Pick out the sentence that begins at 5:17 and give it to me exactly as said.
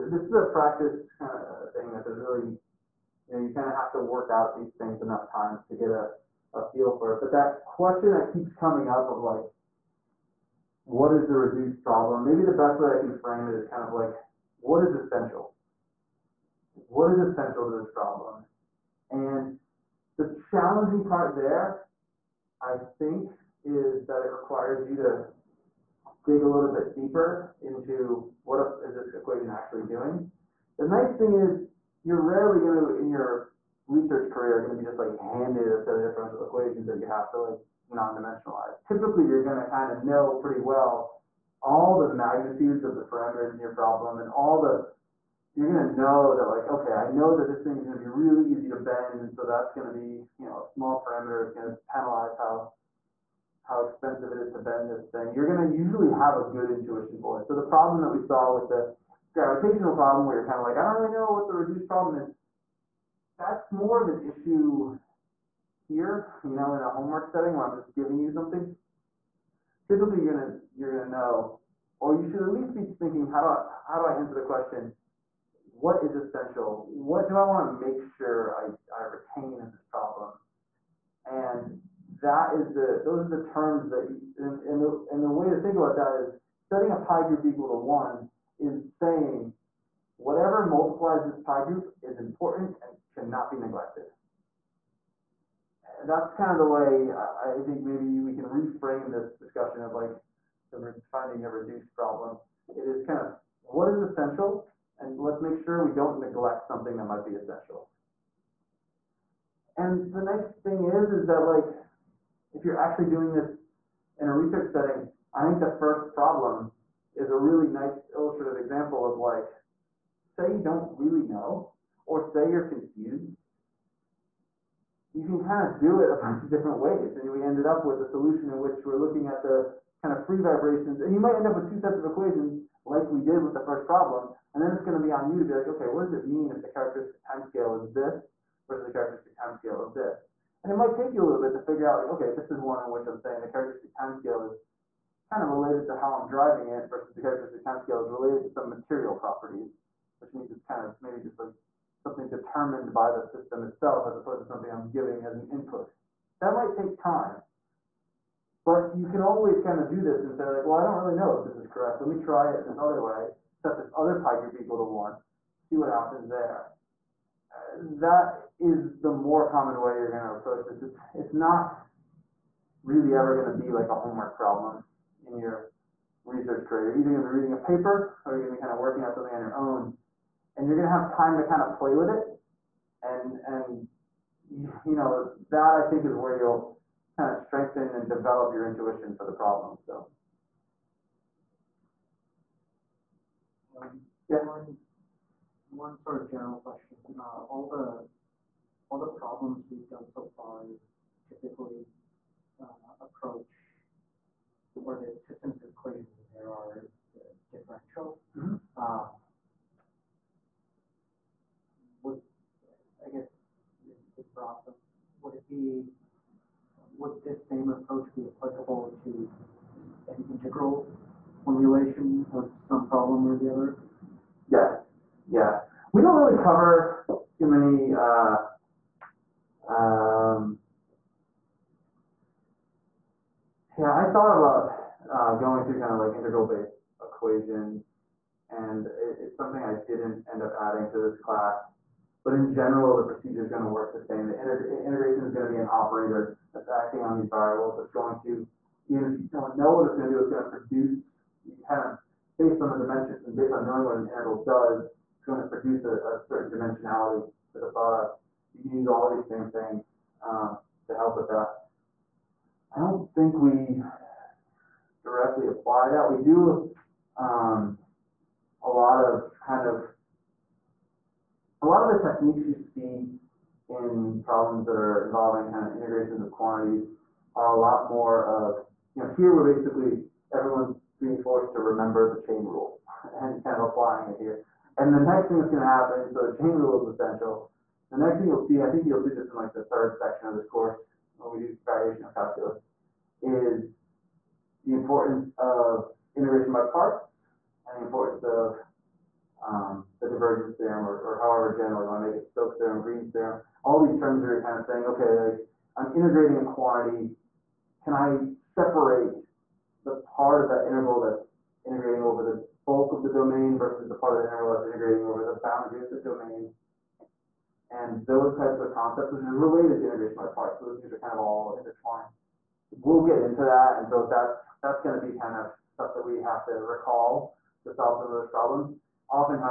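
And those types of concepts, which is related to integration by parts.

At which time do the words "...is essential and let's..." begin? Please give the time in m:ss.
1:43.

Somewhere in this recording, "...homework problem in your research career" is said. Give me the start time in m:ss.
2:53.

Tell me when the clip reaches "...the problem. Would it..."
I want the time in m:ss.
3:34.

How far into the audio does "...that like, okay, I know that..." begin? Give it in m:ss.
0:46.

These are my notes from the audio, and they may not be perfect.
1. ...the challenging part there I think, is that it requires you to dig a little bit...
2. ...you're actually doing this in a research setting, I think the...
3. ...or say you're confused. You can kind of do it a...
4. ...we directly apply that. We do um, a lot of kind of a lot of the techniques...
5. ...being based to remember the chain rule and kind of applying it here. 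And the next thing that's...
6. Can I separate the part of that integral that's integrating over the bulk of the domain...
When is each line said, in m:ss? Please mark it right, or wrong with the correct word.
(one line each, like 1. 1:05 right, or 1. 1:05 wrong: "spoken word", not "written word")
1. 0:20 right
2. 1:52 right
3. 2:02 right
4. 4:23 right
5. 4:40 wrong: "forced", not "based"
6. 5:07 right.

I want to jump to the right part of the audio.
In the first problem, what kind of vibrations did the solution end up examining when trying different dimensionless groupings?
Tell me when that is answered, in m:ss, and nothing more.
2:10.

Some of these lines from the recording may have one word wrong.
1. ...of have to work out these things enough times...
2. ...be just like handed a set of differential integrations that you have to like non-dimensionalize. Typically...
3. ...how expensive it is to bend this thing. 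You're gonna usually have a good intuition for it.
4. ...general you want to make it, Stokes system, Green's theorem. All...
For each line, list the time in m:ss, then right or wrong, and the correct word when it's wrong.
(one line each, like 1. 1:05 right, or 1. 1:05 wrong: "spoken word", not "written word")
1. 0:03 right
2. 0:34 wrong: "equations", not "integrations"
3. 0:53 right
4. 5:01 wrong: "theorem", not "system".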